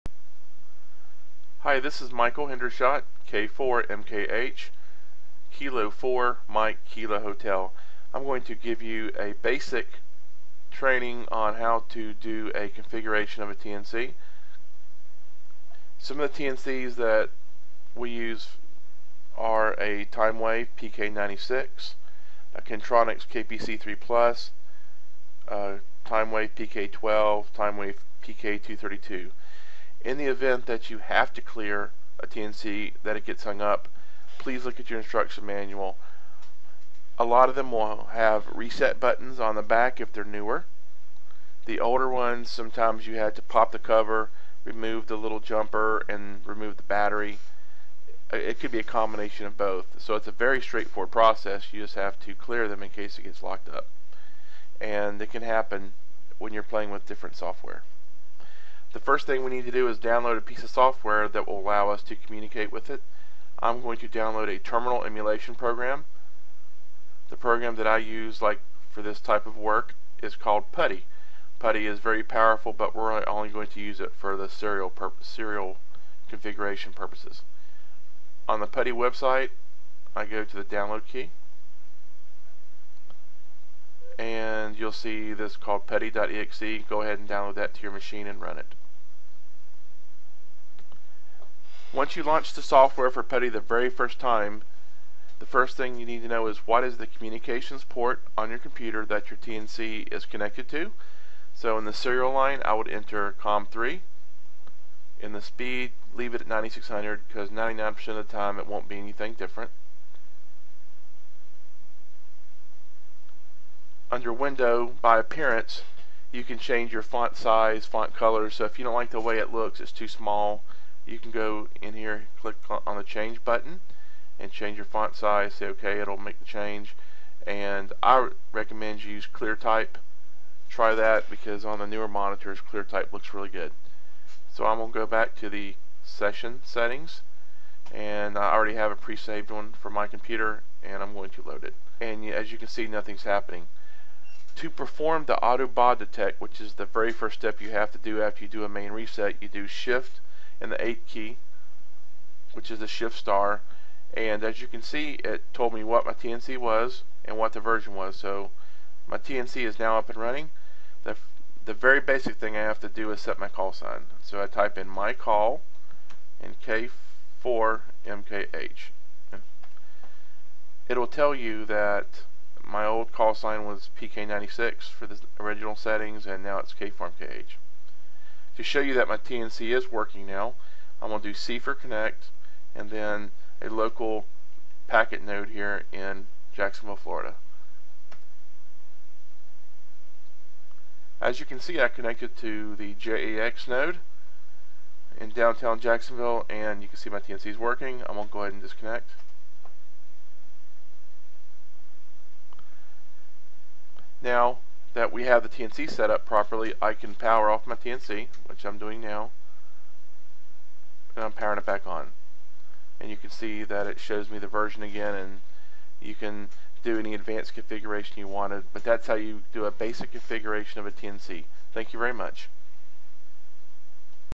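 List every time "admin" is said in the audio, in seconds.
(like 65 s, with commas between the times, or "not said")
not said.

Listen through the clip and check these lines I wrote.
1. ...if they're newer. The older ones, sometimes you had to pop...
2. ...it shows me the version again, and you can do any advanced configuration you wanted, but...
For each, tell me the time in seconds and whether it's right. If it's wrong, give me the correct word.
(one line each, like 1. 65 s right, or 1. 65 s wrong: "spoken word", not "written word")
1. 40 s right
2. 213 s right.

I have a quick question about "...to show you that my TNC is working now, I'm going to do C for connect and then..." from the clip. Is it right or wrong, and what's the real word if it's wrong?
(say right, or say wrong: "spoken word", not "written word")
right.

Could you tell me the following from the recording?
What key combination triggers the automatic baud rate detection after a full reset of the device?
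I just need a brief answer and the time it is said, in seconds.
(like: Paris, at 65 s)
Shift and 8, at 149 s.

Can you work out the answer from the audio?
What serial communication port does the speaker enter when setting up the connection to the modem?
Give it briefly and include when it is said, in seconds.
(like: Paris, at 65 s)
COM3, at 103 s.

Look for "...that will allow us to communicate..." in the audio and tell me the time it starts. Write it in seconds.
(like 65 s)
61 s.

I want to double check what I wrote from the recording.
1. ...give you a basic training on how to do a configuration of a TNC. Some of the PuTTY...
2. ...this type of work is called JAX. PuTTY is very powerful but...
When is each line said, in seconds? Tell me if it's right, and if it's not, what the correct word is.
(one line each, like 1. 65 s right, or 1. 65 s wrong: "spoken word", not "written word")
1. 8 s wrong: "TNCs", not "PuTTY"
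2. 69 s wrong: "PuTTY", not "JAX".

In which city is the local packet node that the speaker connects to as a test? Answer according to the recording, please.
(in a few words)
Jacksonville, Florida.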